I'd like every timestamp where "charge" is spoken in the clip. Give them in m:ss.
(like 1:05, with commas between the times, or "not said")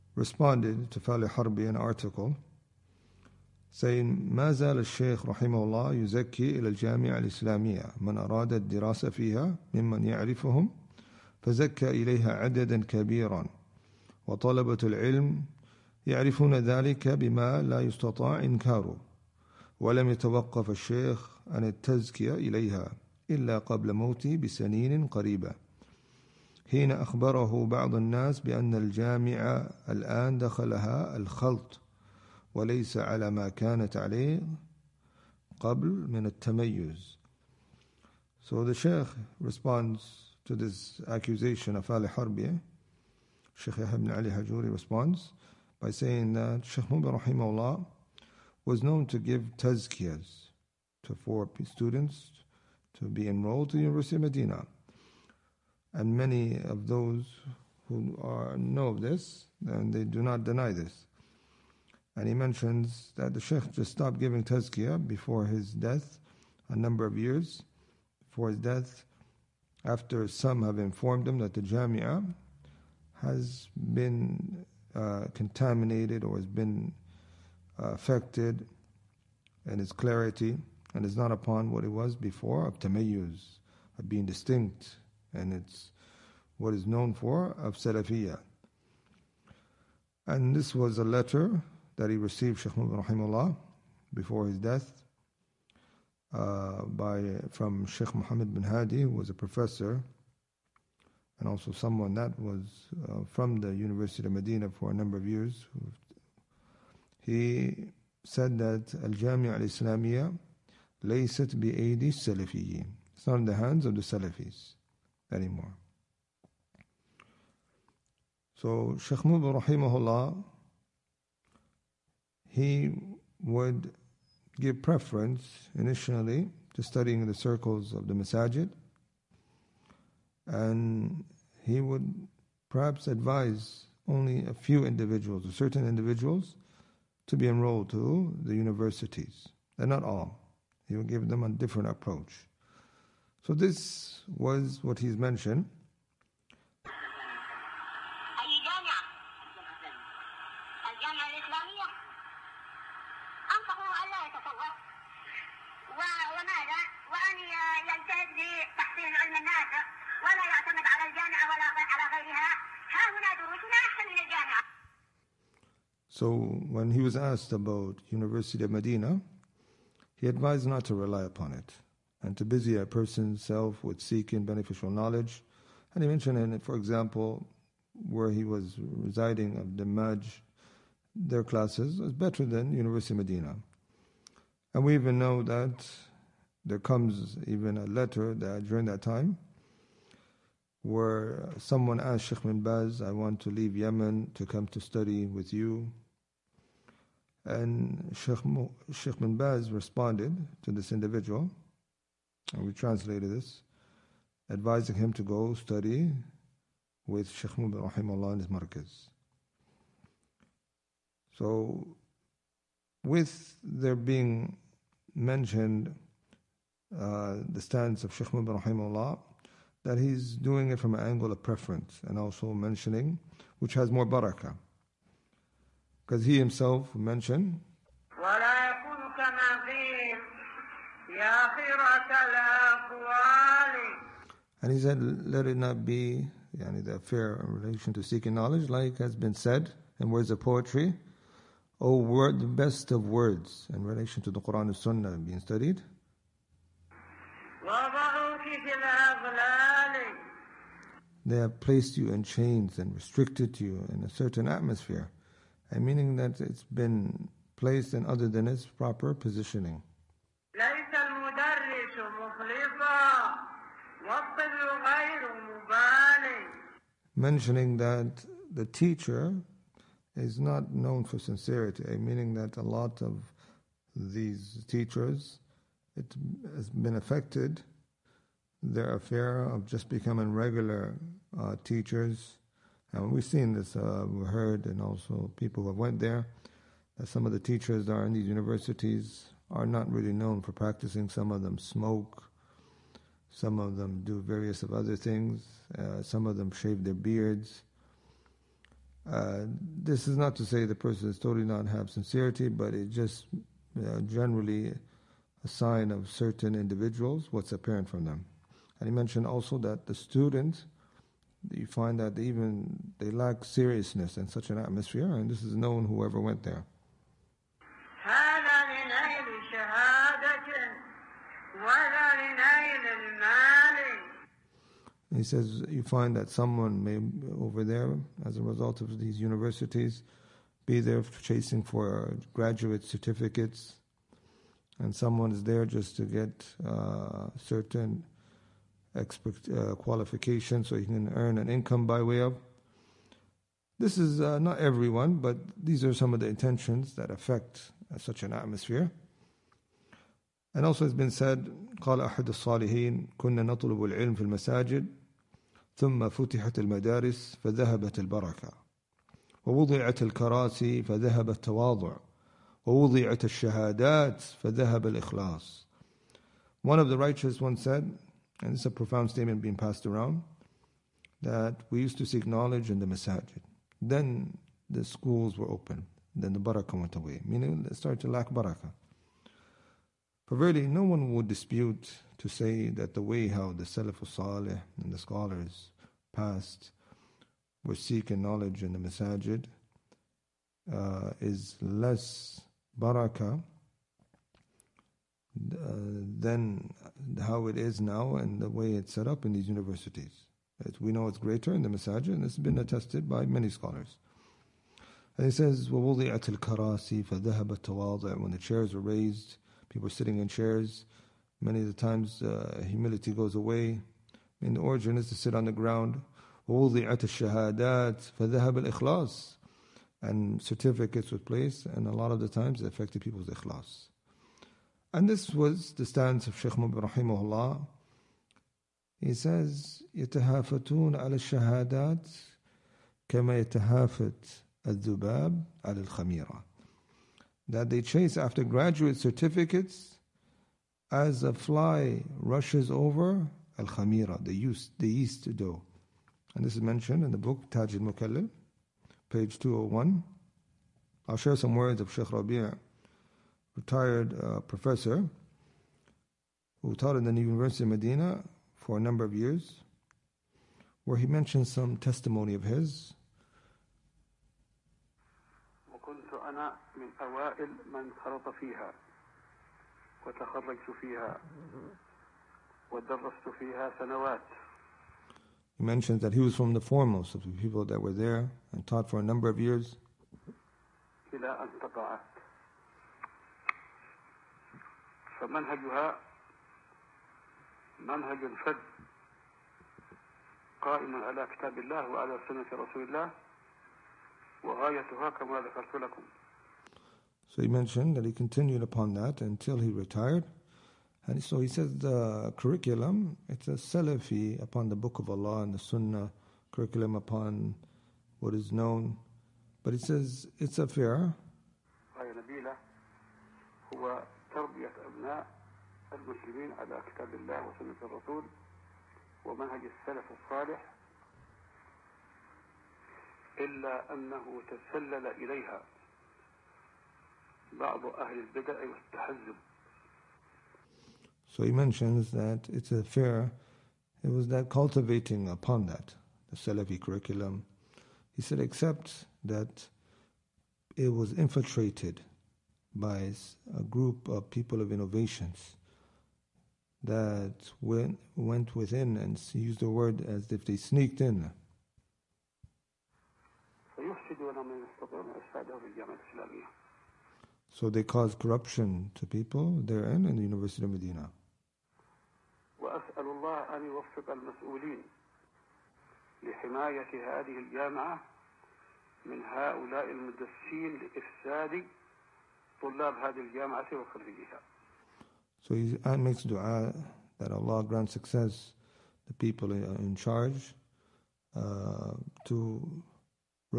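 9:39.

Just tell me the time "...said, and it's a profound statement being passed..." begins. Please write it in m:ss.
6:07.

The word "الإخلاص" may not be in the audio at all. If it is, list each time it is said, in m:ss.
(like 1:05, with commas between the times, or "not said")
6:04, 6:58.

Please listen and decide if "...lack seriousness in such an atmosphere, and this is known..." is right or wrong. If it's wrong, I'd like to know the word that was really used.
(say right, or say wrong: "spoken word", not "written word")
right.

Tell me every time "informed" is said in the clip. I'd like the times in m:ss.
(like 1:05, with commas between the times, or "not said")
1:10.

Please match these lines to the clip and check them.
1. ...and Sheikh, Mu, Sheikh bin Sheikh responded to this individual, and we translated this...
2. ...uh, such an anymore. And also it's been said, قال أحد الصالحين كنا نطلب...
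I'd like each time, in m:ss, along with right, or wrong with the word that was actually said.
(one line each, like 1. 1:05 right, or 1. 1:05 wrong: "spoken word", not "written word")
1. 3:17 wrong: "Baz", not "Sheikh"
2. 5:47 wrong: "atmosphere", not "anymore".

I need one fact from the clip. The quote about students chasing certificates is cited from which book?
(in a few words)
Taj al Mukallil.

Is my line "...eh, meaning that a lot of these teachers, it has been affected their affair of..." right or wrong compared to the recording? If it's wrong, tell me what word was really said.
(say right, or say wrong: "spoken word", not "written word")
right.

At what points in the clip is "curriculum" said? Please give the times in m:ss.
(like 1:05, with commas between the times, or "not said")
8:22, 8:26, 8:56.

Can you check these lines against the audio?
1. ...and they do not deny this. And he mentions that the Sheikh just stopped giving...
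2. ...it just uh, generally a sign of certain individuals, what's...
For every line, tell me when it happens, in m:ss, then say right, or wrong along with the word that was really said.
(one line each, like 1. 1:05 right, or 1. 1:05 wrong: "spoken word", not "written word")
1. 0:59 right
2. 5:02 right.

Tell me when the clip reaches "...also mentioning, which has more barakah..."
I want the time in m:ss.
3:42.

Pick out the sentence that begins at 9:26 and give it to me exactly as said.
وأسأل هذه الجامعة من هؤلاء المدسين لإفساد طلاب هذه الجامعة وخريجها.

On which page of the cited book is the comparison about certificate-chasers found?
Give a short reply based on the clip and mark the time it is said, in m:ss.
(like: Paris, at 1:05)
201, at 7:29.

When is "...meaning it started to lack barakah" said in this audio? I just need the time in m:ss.
6:17.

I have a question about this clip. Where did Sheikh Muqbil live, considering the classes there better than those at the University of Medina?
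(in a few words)
Damaj.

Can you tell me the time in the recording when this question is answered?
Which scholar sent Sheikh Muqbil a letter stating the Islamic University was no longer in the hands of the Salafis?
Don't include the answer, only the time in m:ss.
1:37.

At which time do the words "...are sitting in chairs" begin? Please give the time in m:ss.
6:49.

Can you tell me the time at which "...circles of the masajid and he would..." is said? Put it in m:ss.
2:07.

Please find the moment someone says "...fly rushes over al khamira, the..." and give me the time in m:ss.
7:21.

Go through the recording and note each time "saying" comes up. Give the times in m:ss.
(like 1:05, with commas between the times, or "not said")
0:03, 0:45.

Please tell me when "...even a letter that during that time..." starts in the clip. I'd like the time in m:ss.
3:07.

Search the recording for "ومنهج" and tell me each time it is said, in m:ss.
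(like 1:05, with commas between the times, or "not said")
8:39.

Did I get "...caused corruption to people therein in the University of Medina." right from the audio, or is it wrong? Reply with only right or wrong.
right.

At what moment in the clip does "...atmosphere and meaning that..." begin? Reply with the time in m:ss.
4:14.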